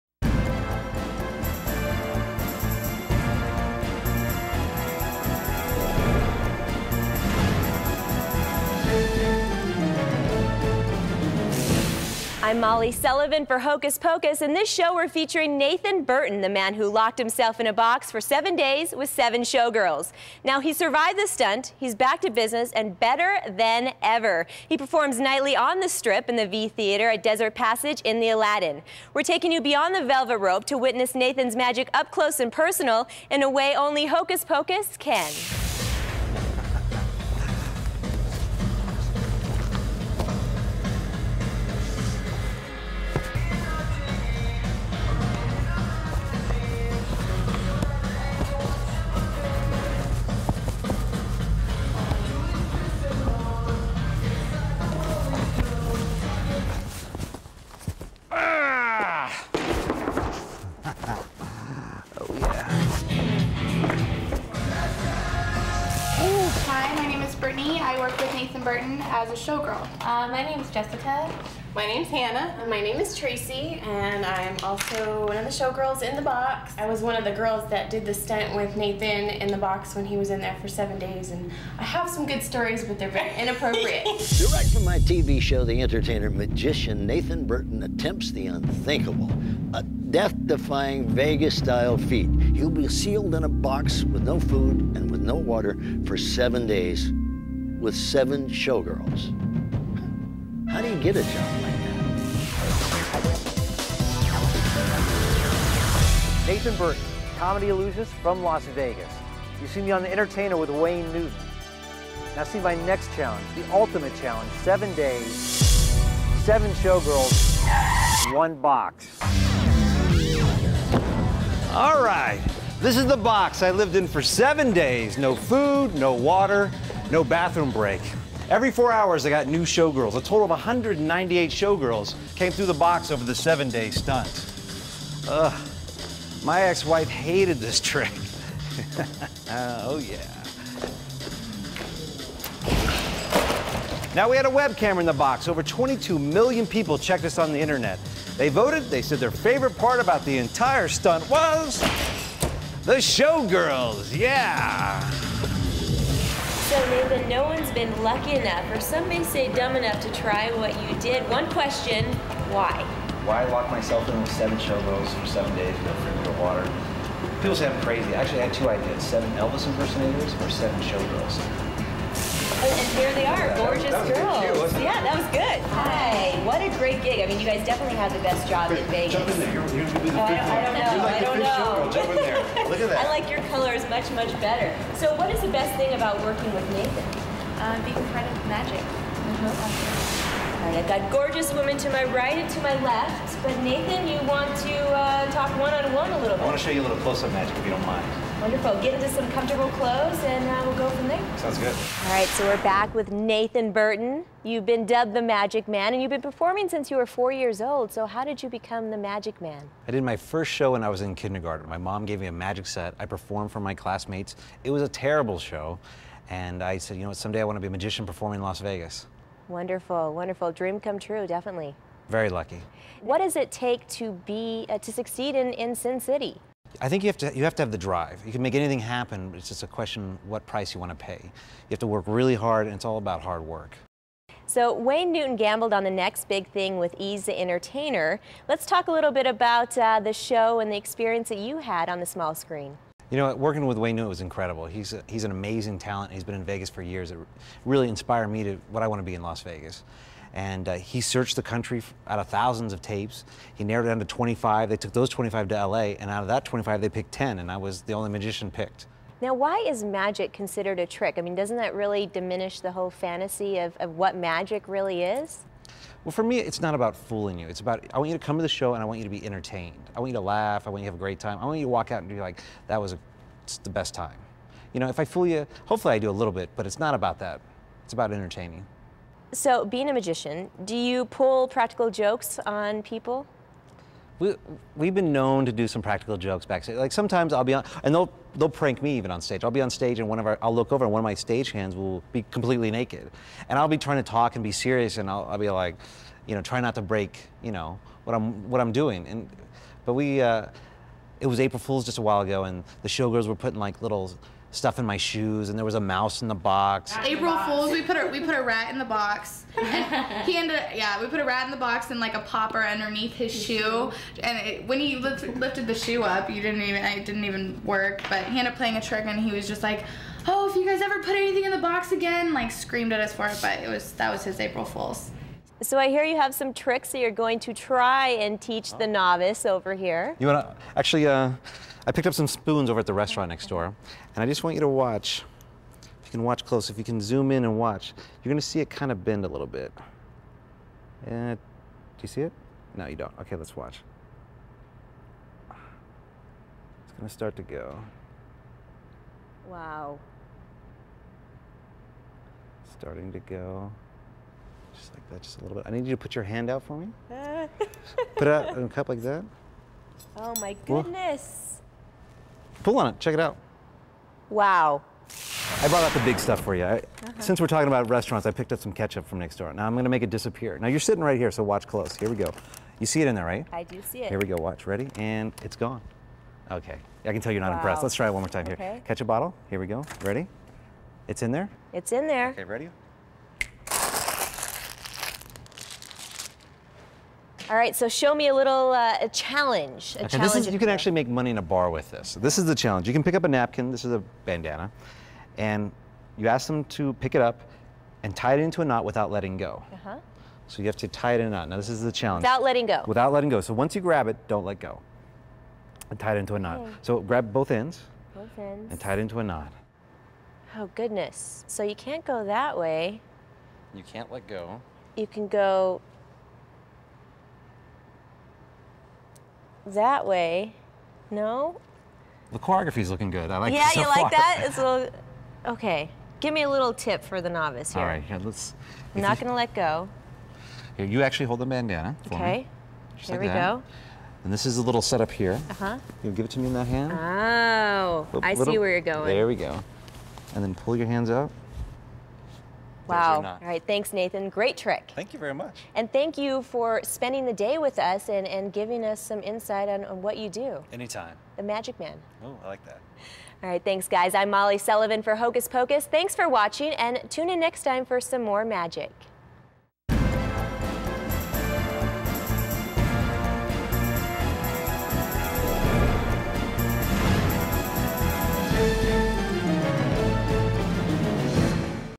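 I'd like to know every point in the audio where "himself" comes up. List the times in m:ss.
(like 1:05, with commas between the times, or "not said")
0:17.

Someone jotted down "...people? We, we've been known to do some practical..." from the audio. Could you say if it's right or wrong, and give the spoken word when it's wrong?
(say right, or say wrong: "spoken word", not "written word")
right.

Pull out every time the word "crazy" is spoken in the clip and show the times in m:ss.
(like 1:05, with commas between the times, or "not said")
2:47.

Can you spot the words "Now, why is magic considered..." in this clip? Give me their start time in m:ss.
4:19.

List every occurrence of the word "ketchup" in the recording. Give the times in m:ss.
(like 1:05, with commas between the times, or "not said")
6:08, 6:18.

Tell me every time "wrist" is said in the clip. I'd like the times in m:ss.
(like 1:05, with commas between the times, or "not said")
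not said.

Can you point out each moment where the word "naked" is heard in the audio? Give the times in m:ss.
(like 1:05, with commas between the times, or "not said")
4:52.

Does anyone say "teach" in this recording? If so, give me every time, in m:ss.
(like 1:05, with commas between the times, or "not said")
5:28.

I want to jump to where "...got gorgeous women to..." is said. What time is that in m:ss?
3:10.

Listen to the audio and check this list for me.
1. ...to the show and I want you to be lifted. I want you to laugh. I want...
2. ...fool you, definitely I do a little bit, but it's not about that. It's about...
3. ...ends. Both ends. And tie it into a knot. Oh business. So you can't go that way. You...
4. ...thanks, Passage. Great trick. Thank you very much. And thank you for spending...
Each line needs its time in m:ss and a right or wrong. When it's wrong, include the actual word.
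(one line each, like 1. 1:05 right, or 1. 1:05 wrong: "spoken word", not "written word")
1. 4:28 wrong: "entertained", not "lifted"
2. 4:35 wrong: "hopefully", not "definitely"
3. 6:47 wrong: "goodness", not "business"
4. 7:23 wrong: "Nathan", not "Passage".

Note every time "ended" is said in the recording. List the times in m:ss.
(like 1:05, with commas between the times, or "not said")
5:10, 5:18.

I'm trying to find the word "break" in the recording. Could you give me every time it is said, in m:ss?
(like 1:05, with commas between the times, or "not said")
2:07, 4:56.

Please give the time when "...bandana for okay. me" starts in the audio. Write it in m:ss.
7:11.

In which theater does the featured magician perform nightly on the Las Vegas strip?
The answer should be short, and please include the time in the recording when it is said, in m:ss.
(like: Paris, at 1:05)
V Theater, at 0:26.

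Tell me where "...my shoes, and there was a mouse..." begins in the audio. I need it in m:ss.
5:04.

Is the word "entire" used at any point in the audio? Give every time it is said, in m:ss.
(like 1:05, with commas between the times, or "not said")
2:30.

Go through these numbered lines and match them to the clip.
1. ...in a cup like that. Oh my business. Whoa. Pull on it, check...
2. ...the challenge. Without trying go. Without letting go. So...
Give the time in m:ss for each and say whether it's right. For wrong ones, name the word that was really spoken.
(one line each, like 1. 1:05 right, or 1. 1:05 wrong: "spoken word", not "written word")
1. 5:58 wrong: "goodness", not "business"
2. 6:41 wrong: "letting", not "trying".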